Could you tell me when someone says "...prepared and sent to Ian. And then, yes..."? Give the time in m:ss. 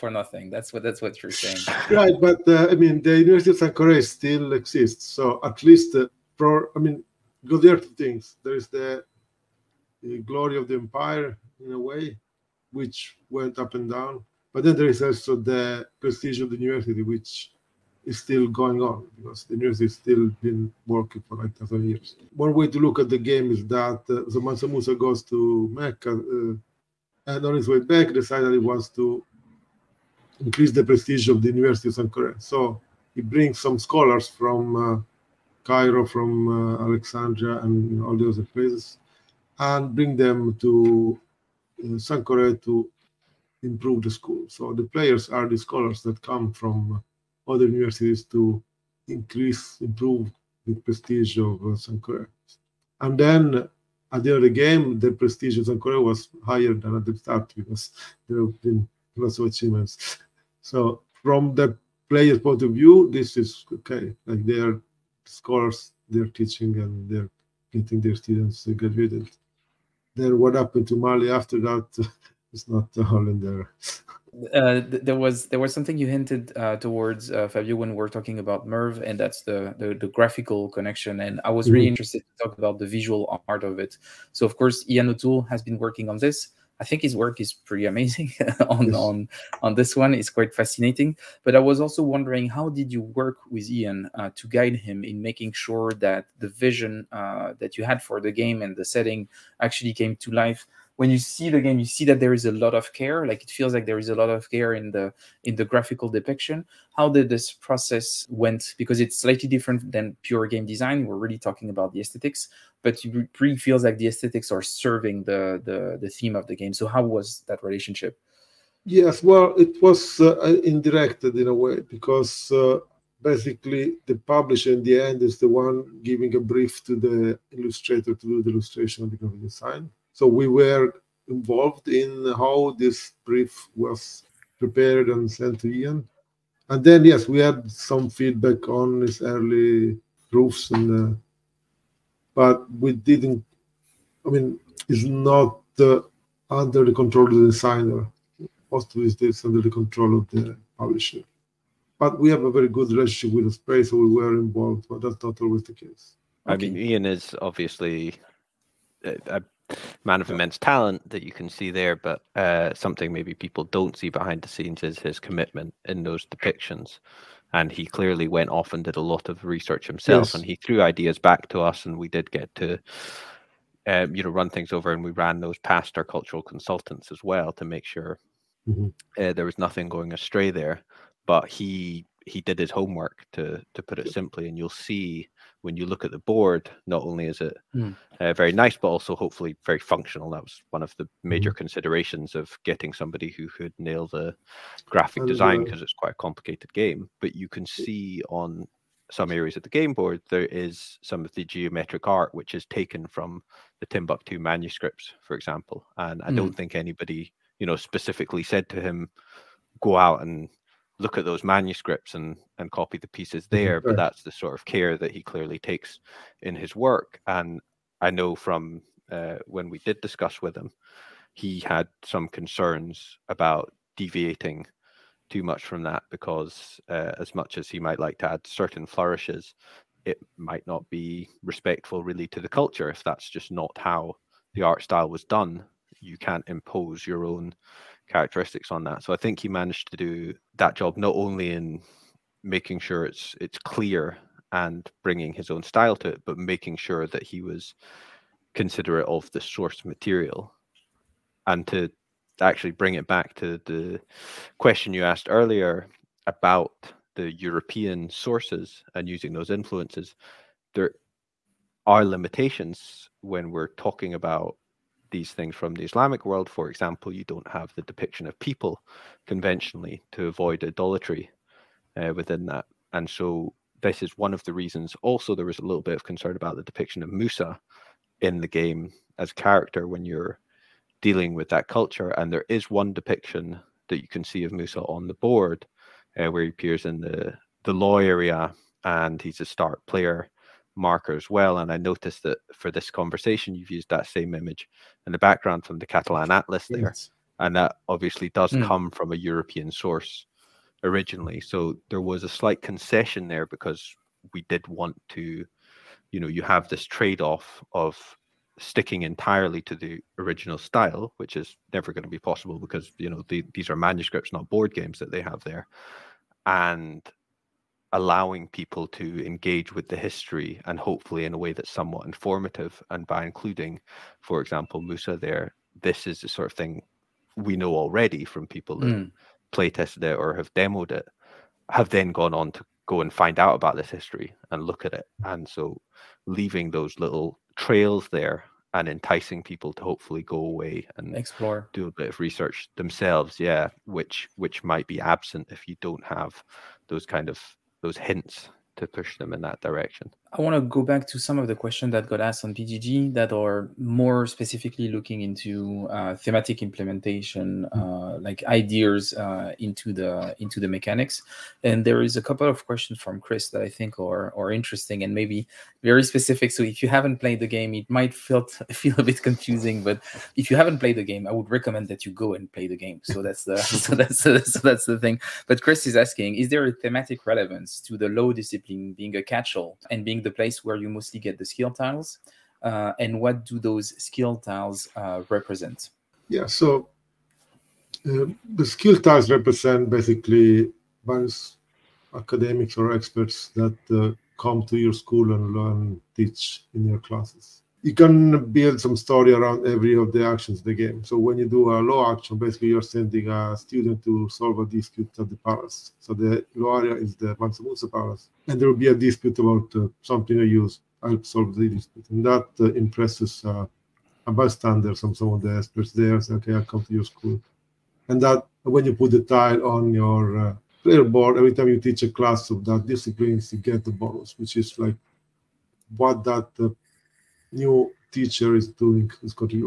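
2:14.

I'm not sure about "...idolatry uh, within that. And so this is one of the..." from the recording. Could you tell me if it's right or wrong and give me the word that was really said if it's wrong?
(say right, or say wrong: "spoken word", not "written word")
right.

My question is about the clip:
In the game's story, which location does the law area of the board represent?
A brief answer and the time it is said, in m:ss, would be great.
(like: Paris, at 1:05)
Mansa Musa Palace, at 6:47.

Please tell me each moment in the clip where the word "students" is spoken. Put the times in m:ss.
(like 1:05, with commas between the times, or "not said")
1:08, 6:43.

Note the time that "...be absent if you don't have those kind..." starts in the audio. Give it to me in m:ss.
5:44.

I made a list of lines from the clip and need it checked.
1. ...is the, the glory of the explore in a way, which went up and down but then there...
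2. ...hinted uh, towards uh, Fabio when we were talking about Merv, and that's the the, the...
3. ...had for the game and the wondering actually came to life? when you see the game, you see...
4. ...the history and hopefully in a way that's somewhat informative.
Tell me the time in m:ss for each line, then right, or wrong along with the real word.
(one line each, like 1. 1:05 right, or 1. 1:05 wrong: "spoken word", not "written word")
1. 0:08 wrong: "empire", not "explore"
2. 1:16 right
3. 1:37 wrong: "setting", not "wondering"
4. 5:19 right.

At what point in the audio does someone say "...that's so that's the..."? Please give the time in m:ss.
6:13.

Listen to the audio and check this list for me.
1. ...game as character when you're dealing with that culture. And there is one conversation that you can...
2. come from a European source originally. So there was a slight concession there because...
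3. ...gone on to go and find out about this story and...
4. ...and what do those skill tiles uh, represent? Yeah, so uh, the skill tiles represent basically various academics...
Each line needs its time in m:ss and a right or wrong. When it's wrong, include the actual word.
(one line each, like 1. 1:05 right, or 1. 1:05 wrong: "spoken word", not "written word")
1. 4:38 wrong: "depiction", not "conversation"
2. 4:58 right
3. 5:32 wrong: "history", not "story"
4. 6:22 right.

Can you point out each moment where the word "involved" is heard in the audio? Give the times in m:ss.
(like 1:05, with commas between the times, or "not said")
2:11, 2:34.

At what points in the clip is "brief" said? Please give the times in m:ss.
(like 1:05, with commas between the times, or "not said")
2:06, 2:13.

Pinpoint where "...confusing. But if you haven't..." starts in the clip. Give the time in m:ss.
6:09.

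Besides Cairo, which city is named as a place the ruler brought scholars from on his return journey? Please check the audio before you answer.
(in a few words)
Alexandria.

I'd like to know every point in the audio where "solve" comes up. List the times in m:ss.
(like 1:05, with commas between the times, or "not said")
6:44, 6:51.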